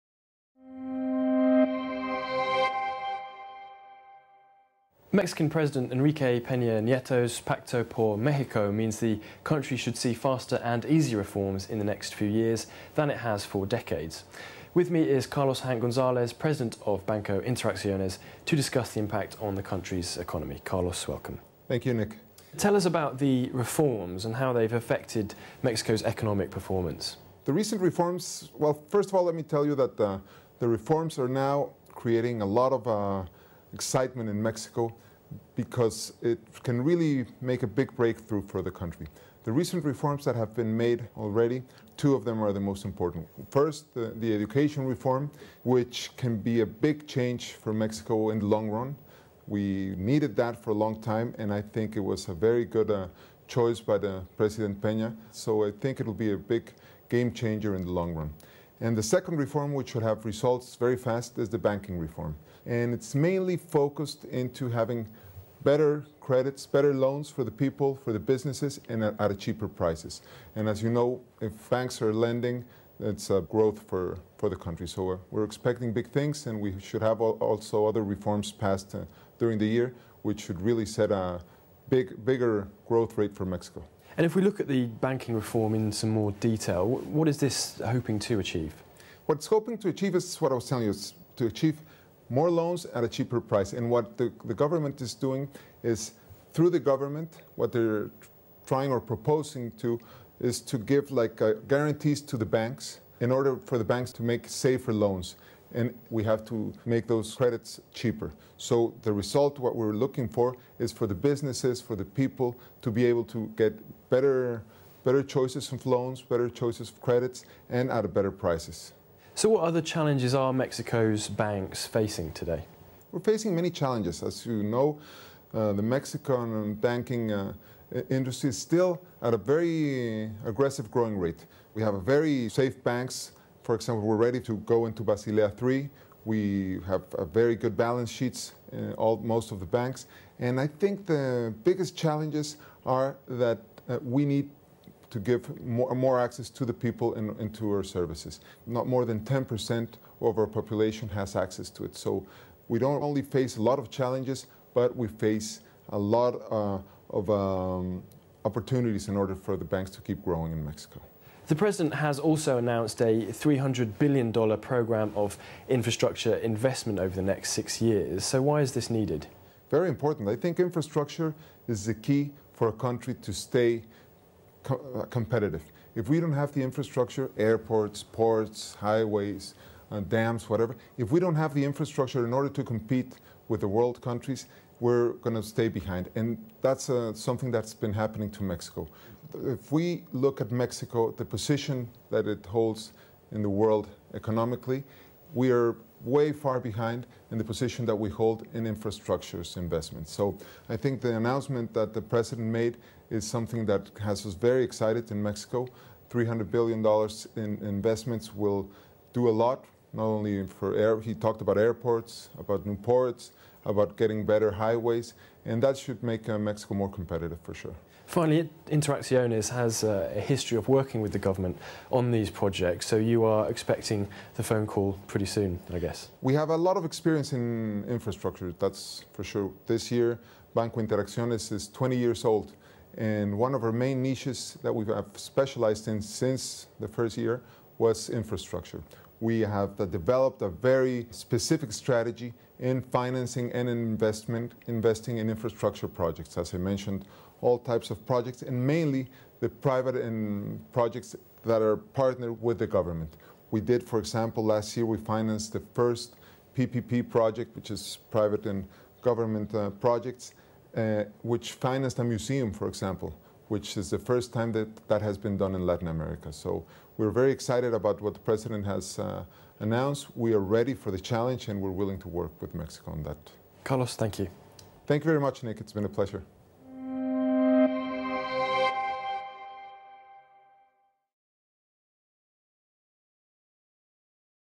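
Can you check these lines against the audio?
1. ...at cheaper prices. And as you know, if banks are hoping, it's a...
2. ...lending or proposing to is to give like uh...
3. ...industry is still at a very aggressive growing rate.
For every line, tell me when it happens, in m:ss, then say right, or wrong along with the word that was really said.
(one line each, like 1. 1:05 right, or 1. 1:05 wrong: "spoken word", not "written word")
1. 1:09 wrong: "lending", not "hoping"
2. 1:38 wrong: "trying", not "lending"
3. 2:08 right.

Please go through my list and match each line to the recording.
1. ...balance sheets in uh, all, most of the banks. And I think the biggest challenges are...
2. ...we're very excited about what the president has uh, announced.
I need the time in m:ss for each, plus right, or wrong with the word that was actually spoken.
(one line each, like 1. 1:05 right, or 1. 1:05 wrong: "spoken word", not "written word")
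1. 2:17 right
2. 4:26 right.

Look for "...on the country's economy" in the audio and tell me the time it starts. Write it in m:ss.
0:19.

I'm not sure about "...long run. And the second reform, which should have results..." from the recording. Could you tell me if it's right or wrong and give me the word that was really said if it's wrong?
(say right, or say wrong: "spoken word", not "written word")
right.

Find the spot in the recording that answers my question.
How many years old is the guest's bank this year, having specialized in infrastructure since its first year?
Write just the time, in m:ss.
3:51.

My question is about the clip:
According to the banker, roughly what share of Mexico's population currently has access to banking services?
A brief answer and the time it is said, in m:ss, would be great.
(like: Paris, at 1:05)
10%, at 2:29.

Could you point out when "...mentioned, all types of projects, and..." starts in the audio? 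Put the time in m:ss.
4:06.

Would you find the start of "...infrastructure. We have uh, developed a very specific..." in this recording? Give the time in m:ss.
3:58.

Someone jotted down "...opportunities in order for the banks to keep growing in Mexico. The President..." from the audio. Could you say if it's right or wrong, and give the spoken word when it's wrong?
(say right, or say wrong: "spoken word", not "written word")
right.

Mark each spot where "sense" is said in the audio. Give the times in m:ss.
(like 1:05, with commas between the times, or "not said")
not said.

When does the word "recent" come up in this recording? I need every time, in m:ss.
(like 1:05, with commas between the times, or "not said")
0:27, 0:39.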